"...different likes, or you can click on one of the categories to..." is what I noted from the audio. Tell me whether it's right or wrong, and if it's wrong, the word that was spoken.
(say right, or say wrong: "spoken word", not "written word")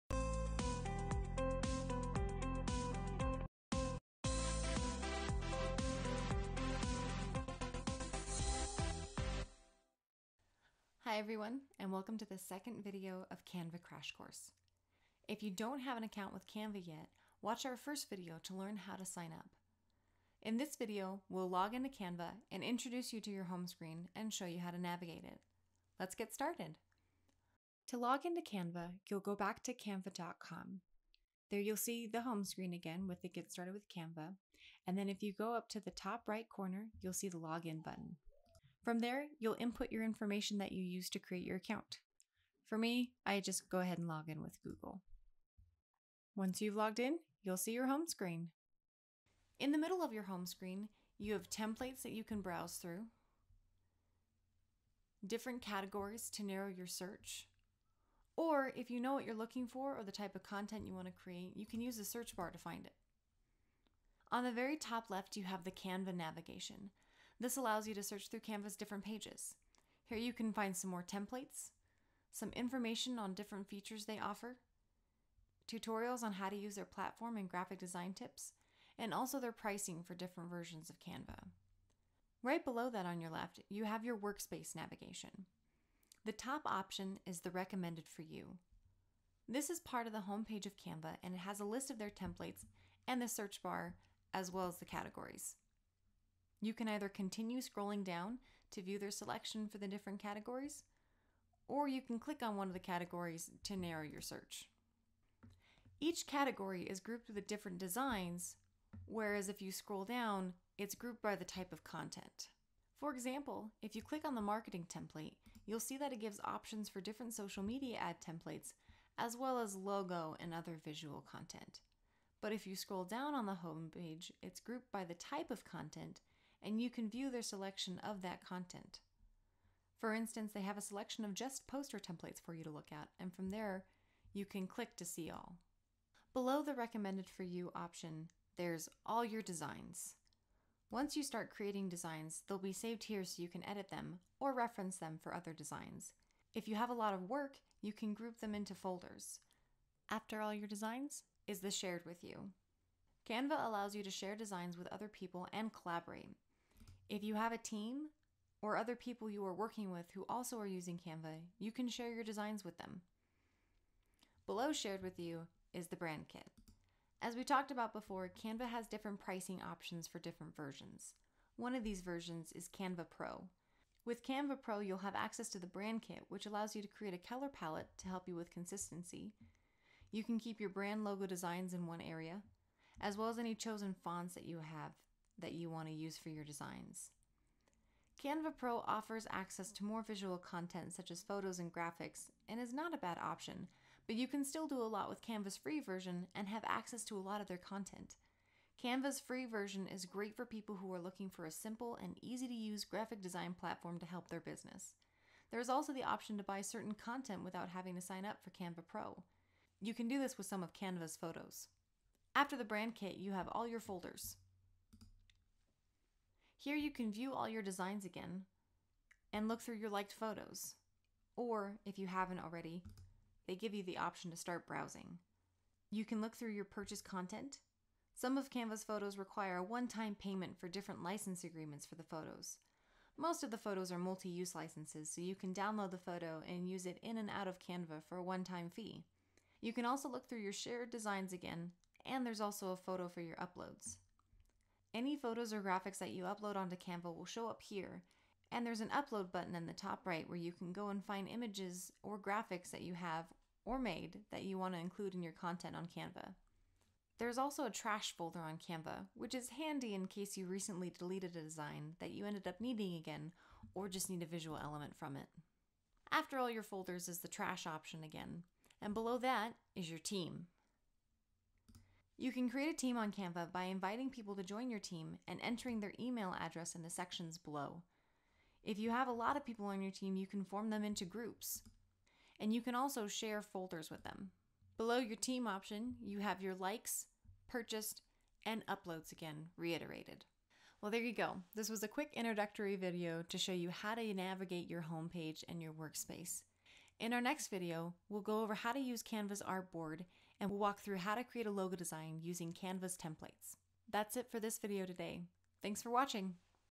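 wrong: "categories", not "likes".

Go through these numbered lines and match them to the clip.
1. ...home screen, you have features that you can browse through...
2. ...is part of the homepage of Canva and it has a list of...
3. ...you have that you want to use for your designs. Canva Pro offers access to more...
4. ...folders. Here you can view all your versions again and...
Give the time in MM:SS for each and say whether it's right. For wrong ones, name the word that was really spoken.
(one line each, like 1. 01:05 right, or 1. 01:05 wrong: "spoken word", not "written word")
1. 00:50 wrong: "templates", not "features"
2. 01:29 right
3. 03:04 right
4. 03:33 wrong: "designs", not "versions".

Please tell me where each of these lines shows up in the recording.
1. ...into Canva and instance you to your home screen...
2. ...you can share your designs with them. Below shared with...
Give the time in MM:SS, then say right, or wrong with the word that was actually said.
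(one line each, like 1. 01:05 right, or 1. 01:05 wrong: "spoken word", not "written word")
1. 00:21 wrong: "introduce", not "instance"
2. 02:41 right.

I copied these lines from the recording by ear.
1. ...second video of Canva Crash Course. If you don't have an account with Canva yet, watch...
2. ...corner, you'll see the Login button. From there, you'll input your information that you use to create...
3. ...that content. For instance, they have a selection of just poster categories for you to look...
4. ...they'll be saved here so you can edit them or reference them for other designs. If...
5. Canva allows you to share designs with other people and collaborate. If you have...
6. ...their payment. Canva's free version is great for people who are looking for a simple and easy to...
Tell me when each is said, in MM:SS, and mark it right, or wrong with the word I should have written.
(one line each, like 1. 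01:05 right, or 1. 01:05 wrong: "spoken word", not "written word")
1. 00:12 right
2. 00:36 right
3. 02:08 wrong: "templates", not "categories"
4. 02:22 right
5. 02:33 right
6. 03:17 wrong: "content", not "payment".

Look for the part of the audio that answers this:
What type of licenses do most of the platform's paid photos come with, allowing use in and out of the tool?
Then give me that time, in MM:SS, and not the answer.
03:53.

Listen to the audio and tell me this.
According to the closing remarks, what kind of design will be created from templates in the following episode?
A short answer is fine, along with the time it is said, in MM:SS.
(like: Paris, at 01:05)
logo design, at 05:01.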